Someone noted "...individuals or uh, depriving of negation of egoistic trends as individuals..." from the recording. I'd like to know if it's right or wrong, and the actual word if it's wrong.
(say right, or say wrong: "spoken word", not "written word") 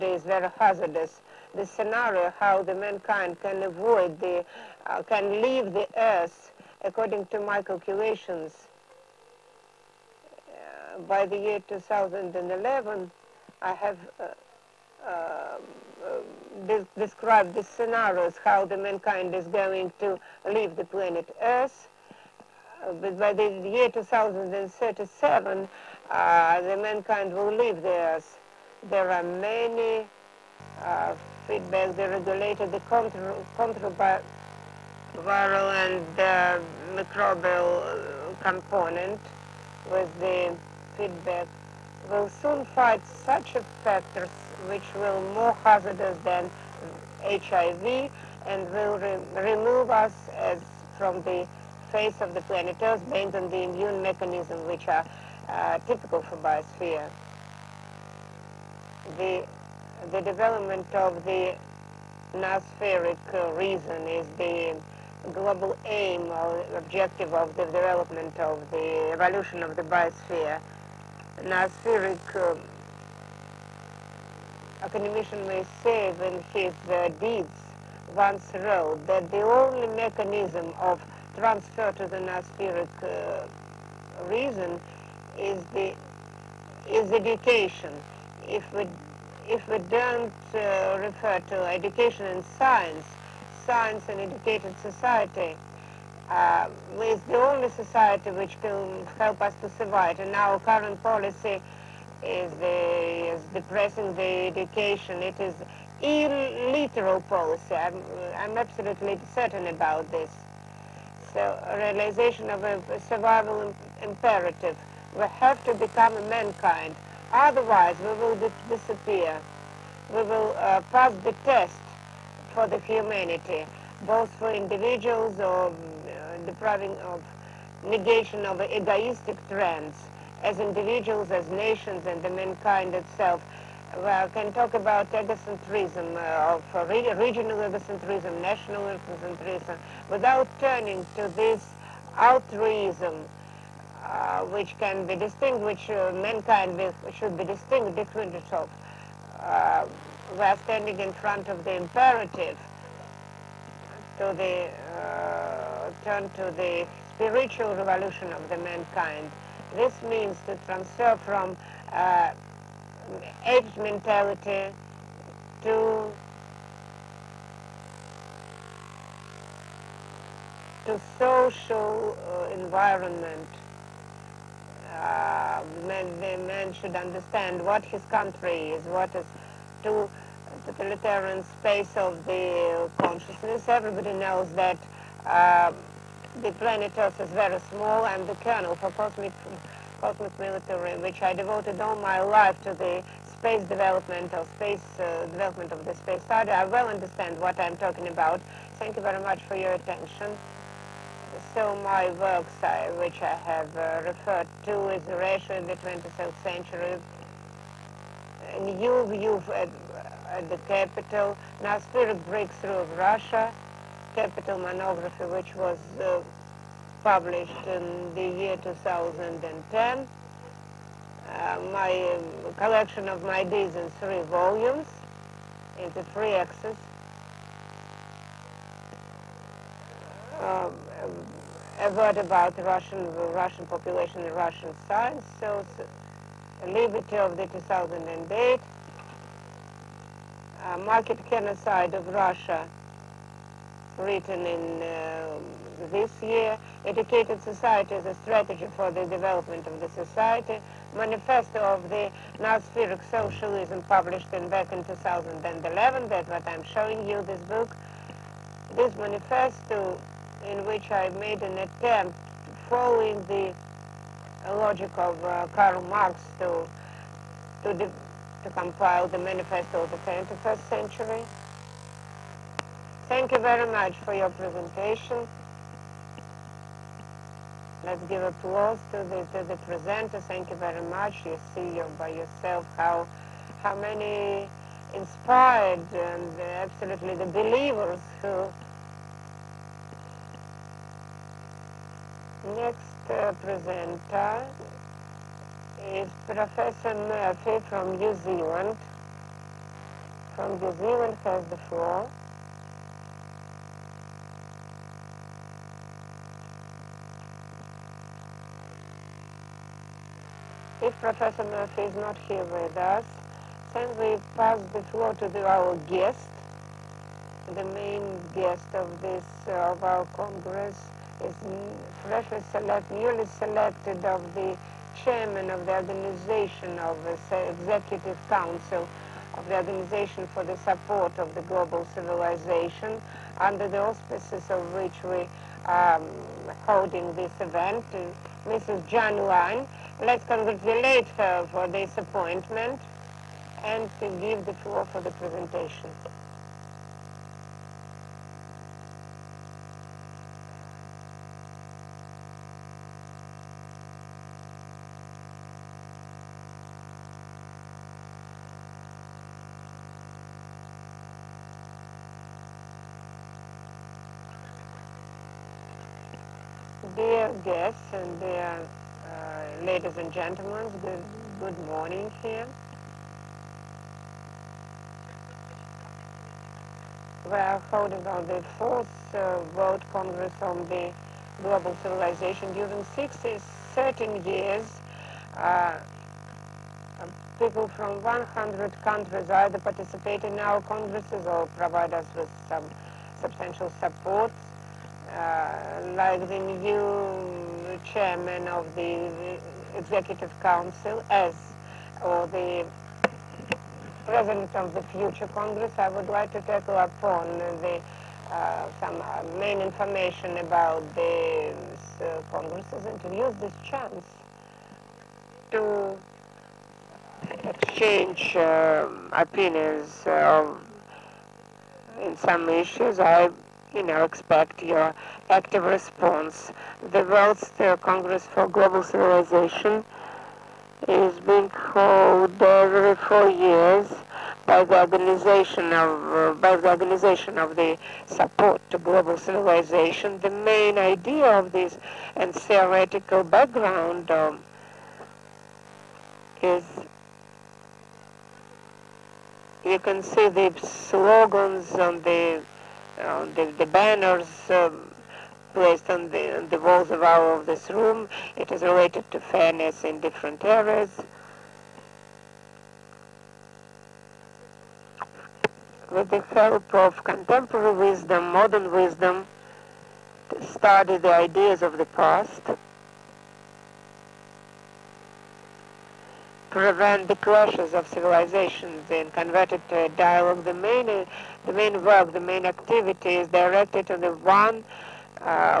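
right.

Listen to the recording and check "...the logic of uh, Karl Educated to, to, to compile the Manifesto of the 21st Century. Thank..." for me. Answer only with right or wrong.
wrong.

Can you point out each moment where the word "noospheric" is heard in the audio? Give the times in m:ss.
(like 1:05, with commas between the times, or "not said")
1:02, 1:22, 4:12.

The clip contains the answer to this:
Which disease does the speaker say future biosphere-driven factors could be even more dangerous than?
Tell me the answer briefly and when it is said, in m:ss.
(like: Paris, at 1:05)
HIV, at 0:47.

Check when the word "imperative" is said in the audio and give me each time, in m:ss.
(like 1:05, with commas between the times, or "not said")
1:54, 2:31.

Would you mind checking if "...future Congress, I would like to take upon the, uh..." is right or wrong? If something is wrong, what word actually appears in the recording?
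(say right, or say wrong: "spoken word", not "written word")
right.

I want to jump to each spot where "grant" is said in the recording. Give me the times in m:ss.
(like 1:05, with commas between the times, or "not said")
not said.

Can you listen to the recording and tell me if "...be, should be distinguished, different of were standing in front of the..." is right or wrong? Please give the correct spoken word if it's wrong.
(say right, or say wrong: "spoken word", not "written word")
right.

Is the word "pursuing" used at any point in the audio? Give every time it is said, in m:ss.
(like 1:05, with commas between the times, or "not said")
not said.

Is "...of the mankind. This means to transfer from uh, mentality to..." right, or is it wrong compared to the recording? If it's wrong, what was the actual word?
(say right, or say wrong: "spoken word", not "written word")
right.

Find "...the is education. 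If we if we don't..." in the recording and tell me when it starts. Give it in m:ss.
1:25.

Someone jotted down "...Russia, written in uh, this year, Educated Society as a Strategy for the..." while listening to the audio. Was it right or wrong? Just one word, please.
right.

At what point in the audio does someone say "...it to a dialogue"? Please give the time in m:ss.
7:59.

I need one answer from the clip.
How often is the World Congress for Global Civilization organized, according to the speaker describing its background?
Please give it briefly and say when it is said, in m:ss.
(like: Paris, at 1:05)
every 4 years, at 7:12.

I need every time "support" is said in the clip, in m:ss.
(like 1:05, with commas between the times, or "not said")
5:30, 6:33, 7:18.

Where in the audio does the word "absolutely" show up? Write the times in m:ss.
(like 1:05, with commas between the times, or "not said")
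1:48, 4:46.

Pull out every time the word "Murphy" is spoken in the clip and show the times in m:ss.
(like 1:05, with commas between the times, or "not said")
4:57, 5:11.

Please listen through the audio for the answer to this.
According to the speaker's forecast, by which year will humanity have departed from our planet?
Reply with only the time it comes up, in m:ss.
0:23.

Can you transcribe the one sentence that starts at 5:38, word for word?
Jan Let's congratulate her for this appointment and give the floor for the presentation.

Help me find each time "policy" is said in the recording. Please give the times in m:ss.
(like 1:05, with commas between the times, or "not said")
1:41, 1:47.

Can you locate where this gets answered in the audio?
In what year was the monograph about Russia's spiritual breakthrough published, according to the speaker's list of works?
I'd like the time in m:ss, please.
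3:38.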